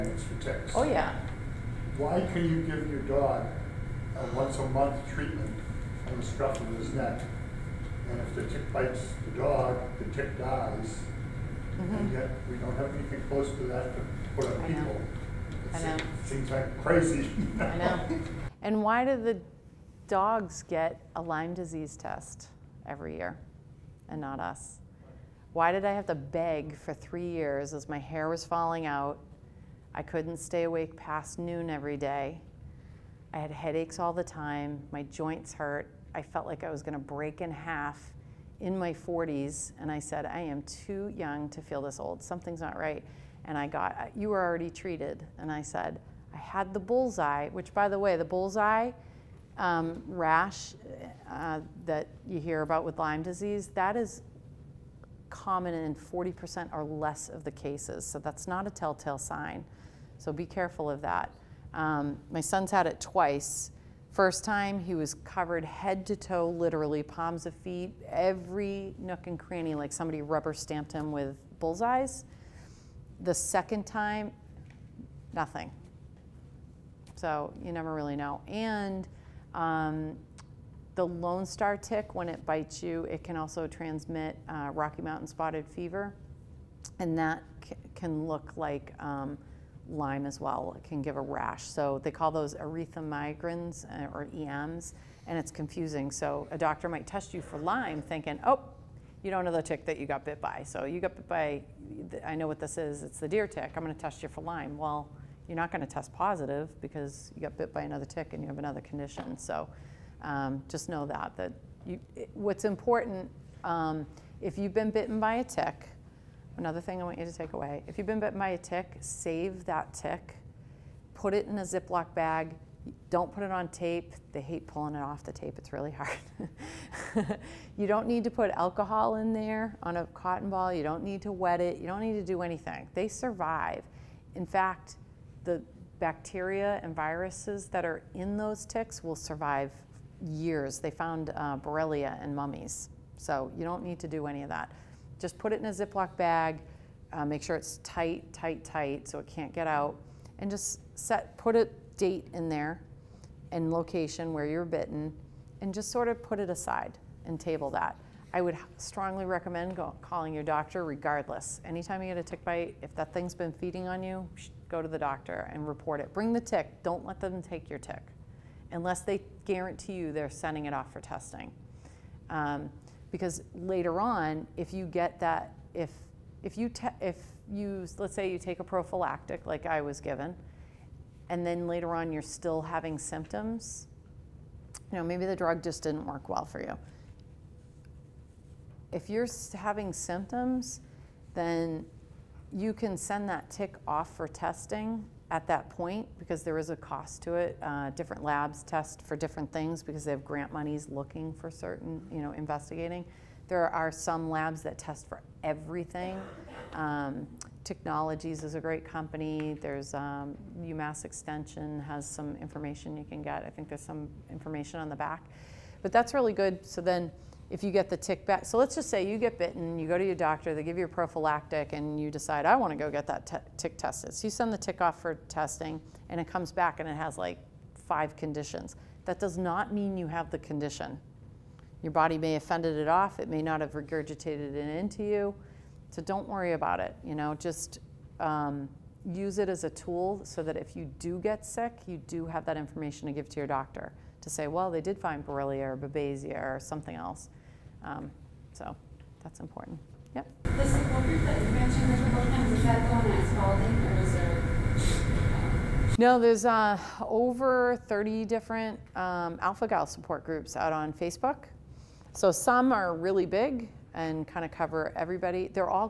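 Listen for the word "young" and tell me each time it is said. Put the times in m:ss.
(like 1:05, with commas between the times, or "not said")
0:41.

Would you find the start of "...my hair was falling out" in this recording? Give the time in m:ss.
0:27.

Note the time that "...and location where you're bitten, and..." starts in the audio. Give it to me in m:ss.
2:33.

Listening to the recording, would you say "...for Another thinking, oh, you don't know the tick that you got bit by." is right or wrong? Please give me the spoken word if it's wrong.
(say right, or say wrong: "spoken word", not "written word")
wrong: "Lyme", not "Another".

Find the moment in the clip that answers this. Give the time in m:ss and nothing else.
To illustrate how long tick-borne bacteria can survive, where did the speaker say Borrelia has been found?
2:22.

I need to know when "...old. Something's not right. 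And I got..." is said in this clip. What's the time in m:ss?
0:41.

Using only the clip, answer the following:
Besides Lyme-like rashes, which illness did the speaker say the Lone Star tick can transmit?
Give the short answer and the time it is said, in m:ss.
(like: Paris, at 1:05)
Rocky Mountain spotted fever, at 1:24.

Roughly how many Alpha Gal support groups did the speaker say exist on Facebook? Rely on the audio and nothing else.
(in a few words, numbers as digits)
Over 30.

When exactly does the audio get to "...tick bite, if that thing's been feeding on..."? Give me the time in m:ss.
2:42.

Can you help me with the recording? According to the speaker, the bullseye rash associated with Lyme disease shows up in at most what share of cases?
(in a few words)
40%.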